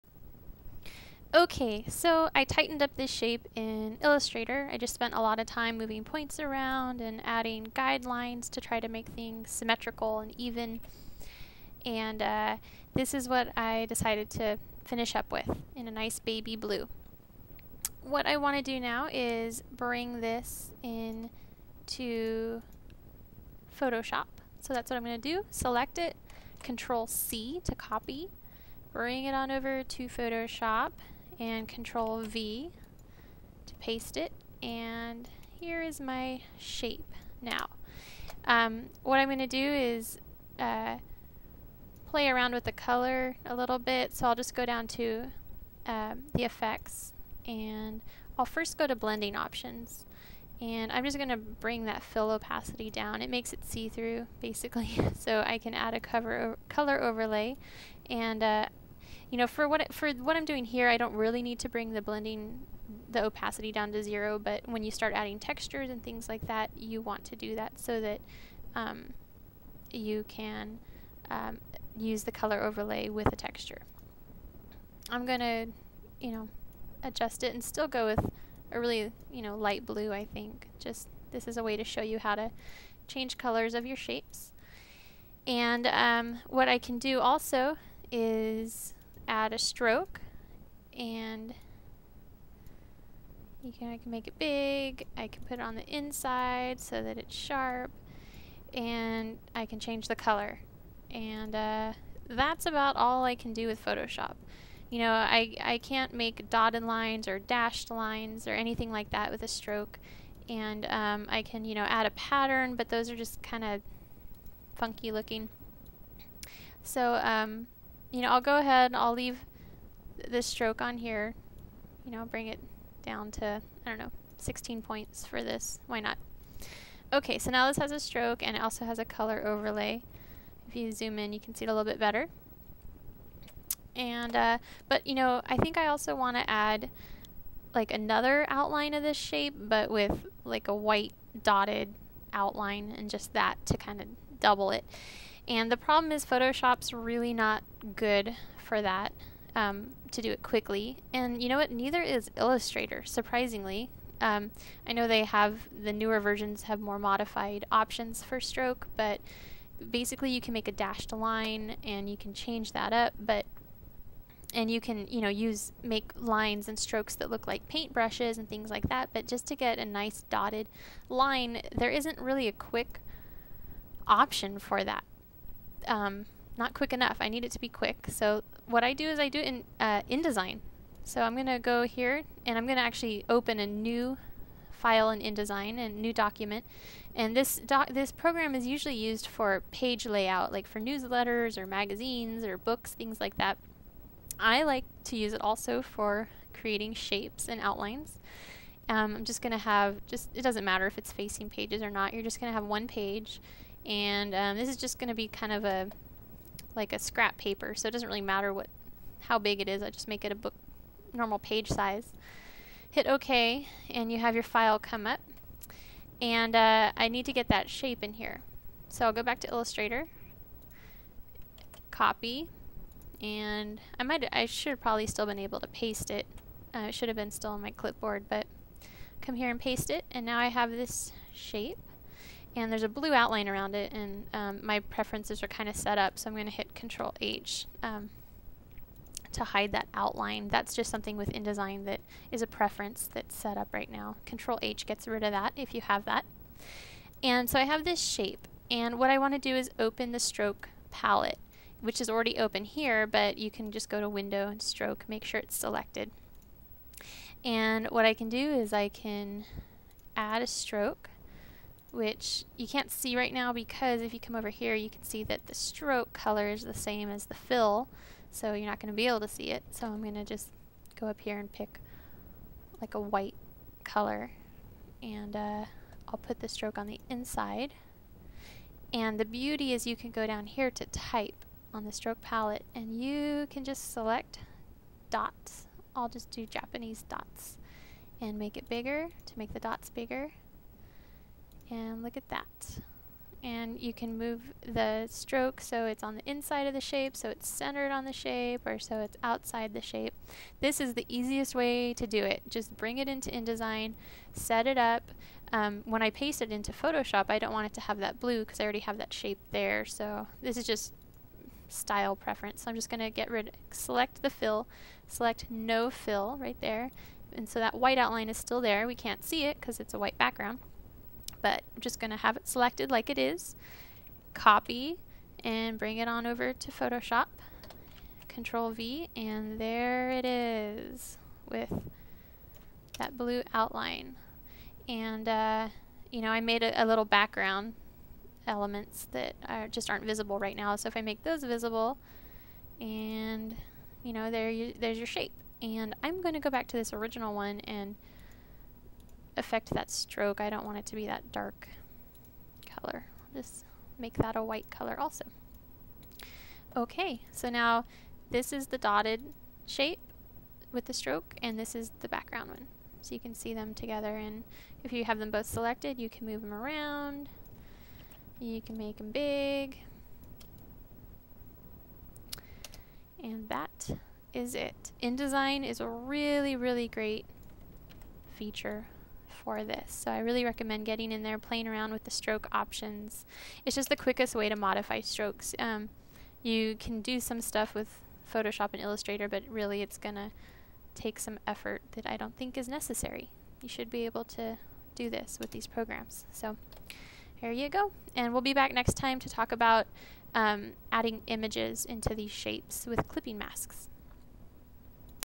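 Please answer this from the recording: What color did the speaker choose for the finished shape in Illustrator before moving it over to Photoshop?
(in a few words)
baby blue.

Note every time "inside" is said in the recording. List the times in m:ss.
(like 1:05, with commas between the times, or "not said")
1:35, 4:37, 4:56.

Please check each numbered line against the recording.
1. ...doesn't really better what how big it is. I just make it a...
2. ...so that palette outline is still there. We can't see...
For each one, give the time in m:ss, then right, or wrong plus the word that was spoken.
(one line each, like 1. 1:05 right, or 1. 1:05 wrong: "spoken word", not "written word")
1. 3:27 wrong: "matter", not "better"
2. 5:17 wrong: "white", not "palette".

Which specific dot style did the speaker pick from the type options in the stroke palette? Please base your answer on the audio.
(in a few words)
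Japanese dots.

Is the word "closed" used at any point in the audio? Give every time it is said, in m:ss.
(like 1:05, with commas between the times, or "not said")
not said.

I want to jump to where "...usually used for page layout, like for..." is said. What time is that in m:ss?
3:08.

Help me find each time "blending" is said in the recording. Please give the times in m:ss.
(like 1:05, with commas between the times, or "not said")
0:48, 1:02.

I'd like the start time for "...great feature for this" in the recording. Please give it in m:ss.
6:16.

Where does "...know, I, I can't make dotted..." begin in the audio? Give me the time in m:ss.
1:44.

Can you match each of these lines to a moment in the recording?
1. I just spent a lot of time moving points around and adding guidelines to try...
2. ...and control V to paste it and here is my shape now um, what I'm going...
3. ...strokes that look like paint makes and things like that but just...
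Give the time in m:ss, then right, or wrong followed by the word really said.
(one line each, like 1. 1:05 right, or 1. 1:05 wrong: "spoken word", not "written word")
1. 0:04 right
2. 0:31 right
3. 2:46 wrong: "brushes", not "makes".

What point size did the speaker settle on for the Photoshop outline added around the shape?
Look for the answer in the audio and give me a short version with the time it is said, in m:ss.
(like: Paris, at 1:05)
16 points, at 2:04.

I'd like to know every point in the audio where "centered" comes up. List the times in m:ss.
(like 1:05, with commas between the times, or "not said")
4:57.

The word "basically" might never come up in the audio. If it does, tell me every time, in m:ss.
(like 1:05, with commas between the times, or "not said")
0:54, 2:39.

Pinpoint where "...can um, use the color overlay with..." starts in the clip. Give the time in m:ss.
1:10.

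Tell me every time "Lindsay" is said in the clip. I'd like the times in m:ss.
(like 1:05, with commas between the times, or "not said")
not said.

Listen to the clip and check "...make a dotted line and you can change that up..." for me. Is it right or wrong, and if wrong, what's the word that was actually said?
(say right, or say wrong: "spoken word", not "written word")
wrong: "dashed", not "dotted".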